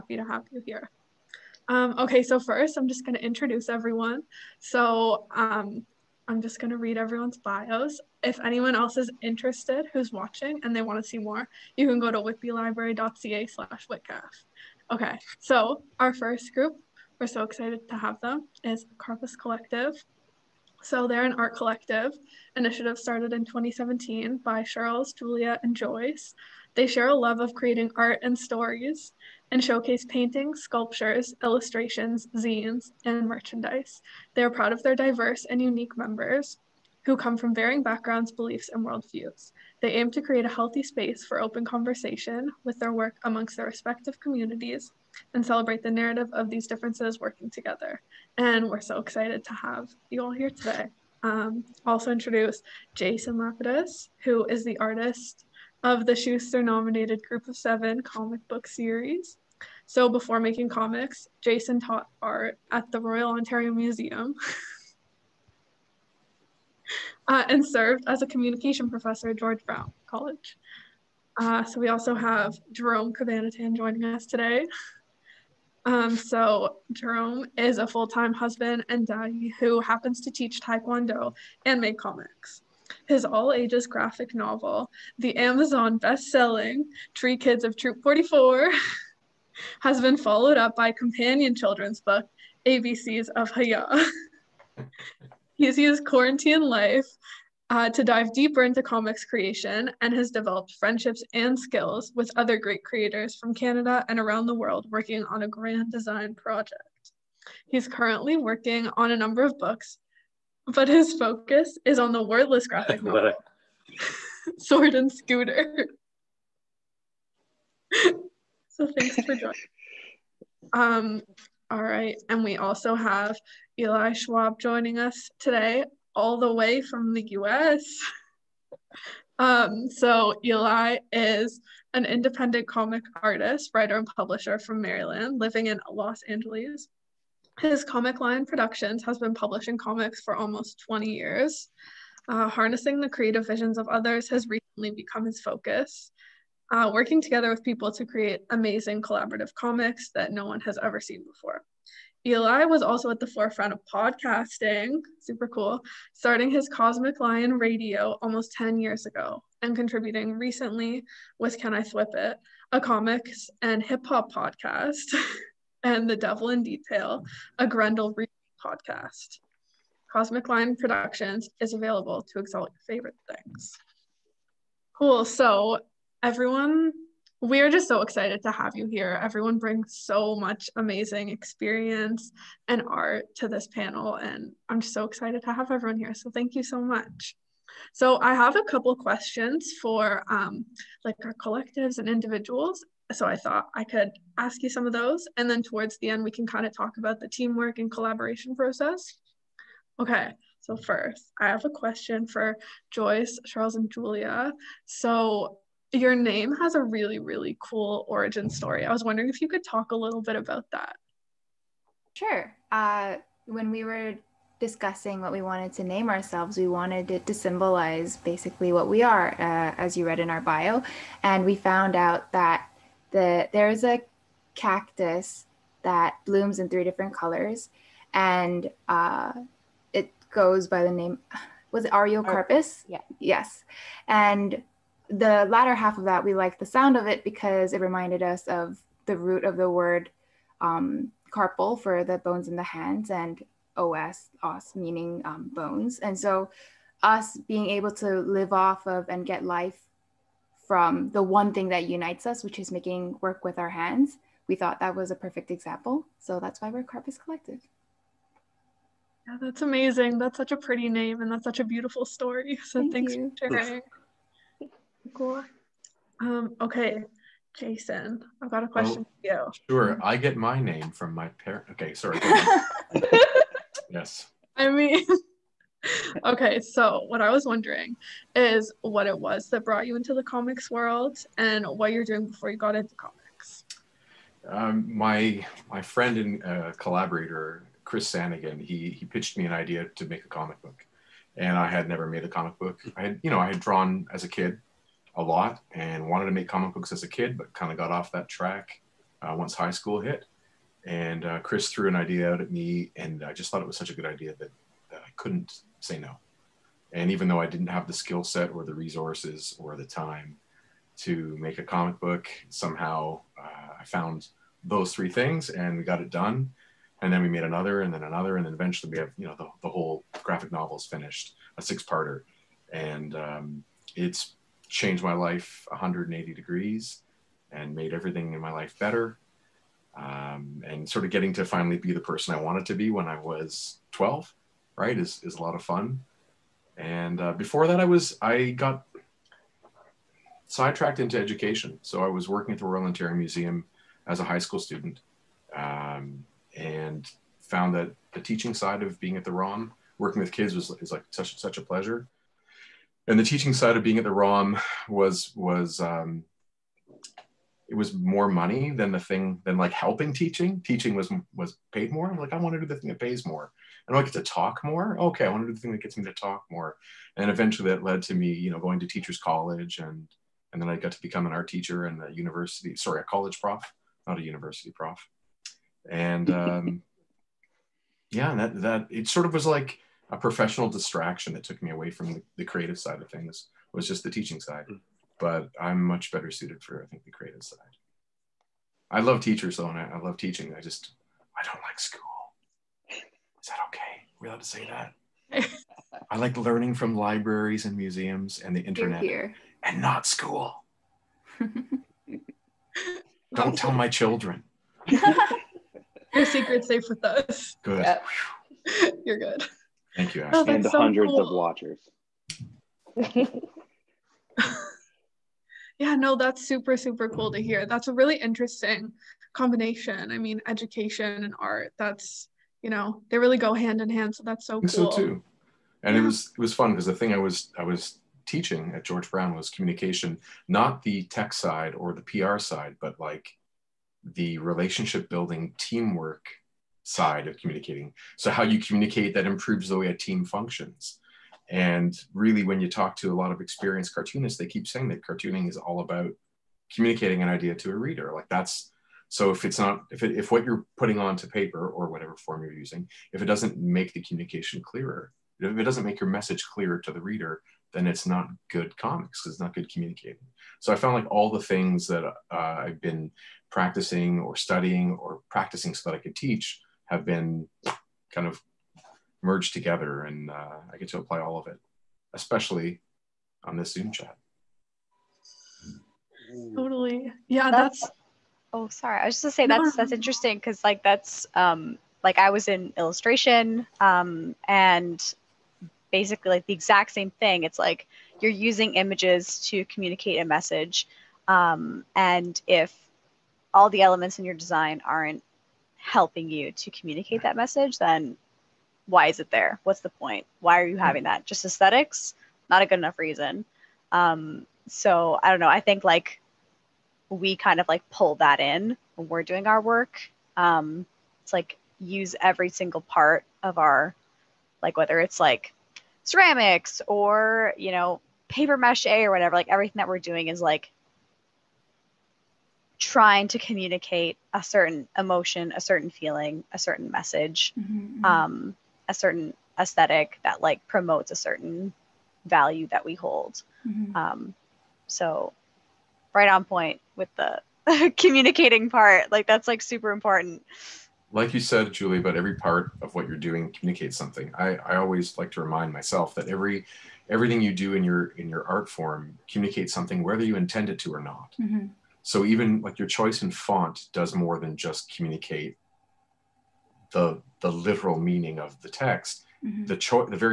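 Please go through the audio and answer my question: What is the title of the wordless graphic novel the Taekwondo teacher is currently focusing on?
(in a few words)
Sword and Scooter.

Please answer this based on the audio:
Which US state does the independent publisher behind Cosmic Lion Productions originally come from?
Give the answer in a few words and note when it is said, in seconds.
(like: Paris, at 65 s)
Maryland, at 134 s.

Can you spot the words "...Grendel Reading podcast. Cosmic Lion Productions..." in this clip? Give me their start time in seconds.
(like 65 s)
167 s.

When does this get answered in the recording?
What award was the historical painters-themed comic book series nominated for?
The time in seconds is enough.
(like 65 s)
56 s.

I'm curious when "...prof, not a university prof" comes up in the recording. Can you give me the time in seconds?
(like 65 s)
373 s.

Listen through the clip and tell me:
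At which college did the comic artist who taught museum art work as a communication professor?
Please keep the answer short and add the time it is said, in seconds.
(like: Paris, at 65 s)
George Brown College, at 69 s.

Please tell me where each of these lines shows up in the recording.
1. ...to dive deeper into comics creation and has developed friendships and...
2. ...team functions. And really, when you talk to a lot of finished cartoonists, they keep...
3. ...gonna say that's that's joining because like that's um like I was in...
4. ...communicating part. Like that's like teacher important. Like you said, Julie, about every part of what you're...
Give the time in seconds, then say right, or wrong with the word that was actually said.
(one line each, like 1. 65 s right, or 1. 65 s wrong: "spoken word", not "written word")
1. 97 s right
2. 439 s wrong: "experienced", not "finished"
3. 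479 s wrong: "interesting", not "joining"
4. 537 s wrong: "super", not "teacher".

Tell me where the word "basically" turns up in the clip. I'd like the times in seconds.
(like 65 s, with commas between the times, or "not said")
218 s, 485 s.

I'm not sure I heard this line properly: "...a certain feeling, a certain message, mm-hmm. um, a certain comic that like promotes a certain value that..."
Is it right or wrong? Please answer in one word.
wrong.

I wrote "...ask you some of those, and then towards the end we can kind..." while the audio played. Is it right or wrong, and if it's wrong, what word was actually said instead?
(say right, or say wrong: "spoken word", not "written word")
right.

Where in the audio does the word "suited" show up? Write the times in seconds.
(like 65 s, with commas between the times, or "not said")
386 s.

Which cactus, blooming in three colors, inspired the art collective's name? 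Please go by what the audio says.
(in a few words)
Ariocarpus.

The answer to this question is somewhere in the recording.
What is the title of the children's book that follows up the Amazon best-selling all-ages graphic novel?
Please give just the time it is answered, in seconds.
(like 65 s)
92 s.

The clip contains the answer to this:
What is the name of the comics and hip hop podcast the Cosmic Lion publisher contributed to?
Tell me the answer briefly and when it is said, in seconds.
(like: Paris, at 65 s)
Can I Flip It, at 161 s.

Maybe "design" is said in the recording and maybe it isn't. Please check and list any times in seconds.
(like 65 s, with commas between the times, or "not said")
105 s, 494 s.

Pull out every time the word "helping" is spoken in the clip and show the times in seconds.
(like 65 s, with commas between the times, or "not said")
359 s, 495 s.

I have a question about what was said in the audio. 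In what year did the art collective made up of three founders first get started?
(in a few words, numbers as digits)
2017.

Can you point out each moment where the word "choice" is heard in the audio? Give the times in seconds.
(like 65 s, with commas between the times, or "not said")
552 s, 559 s.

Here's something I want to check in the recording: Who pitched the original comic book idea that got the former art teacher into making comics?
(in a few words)
Chris Sanigan.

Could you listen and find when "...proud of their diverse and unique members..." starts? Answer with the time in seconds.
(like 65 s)
34 s.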